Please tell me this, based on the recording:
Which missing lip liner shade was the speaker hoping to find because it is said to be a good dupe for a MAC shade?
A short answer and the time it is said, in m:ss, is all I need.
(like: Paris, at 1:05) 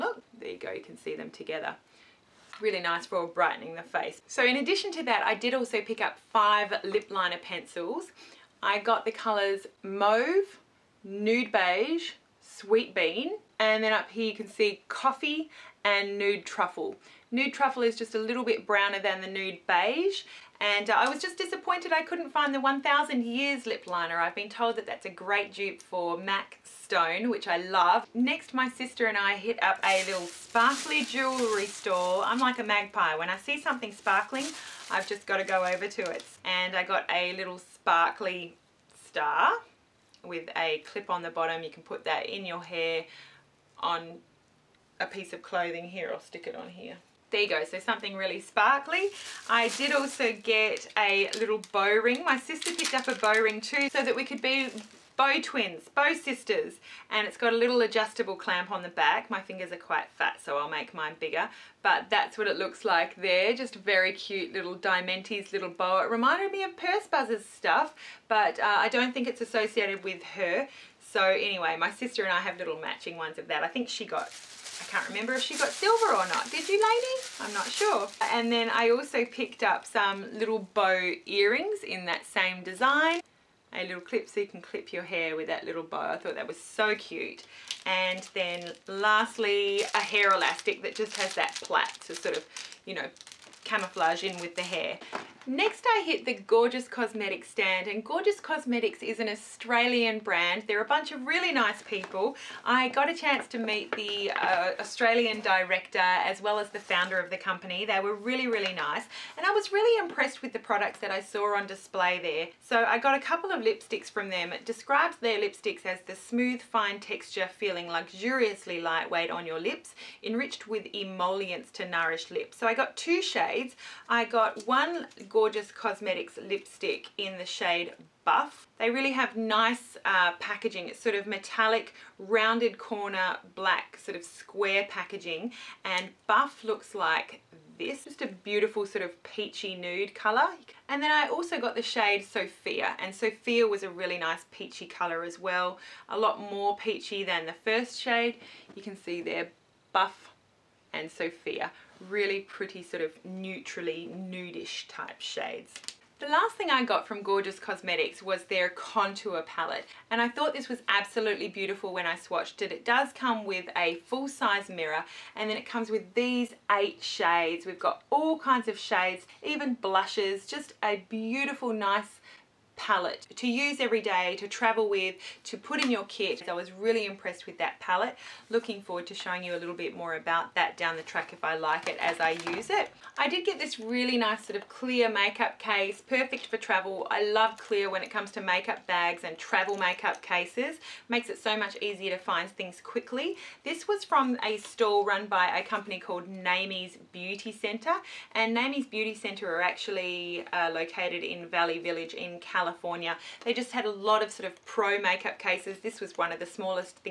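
1000 Years, at 0:22.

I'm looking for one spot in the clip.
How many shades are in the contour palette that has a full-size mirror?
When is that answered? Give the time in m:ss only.
2:46.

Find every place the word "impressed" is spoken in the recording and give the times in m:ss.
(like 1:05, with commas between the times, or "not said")
1:49, 2:57.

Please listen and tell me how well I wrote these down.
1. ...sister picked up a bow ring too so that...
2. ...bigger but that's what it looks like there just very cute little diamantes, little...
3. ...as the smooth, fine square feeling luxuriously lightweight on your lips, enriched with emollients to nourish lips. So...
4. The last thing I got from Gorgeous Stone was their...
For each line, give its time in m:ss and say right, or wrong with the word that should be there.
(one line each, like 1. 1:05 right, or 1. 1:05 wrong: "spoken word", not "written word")
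1. 0:52 right
2. 1:01 right
3. 1:55 wrong: "texture", not "square"
4. 2:36 wrong: "Cosmetics", not "Stone".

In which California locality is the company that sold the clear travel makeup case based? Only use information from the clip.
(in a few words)
Valley Village.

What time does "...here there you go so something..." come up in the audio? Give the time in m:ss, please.
0:46.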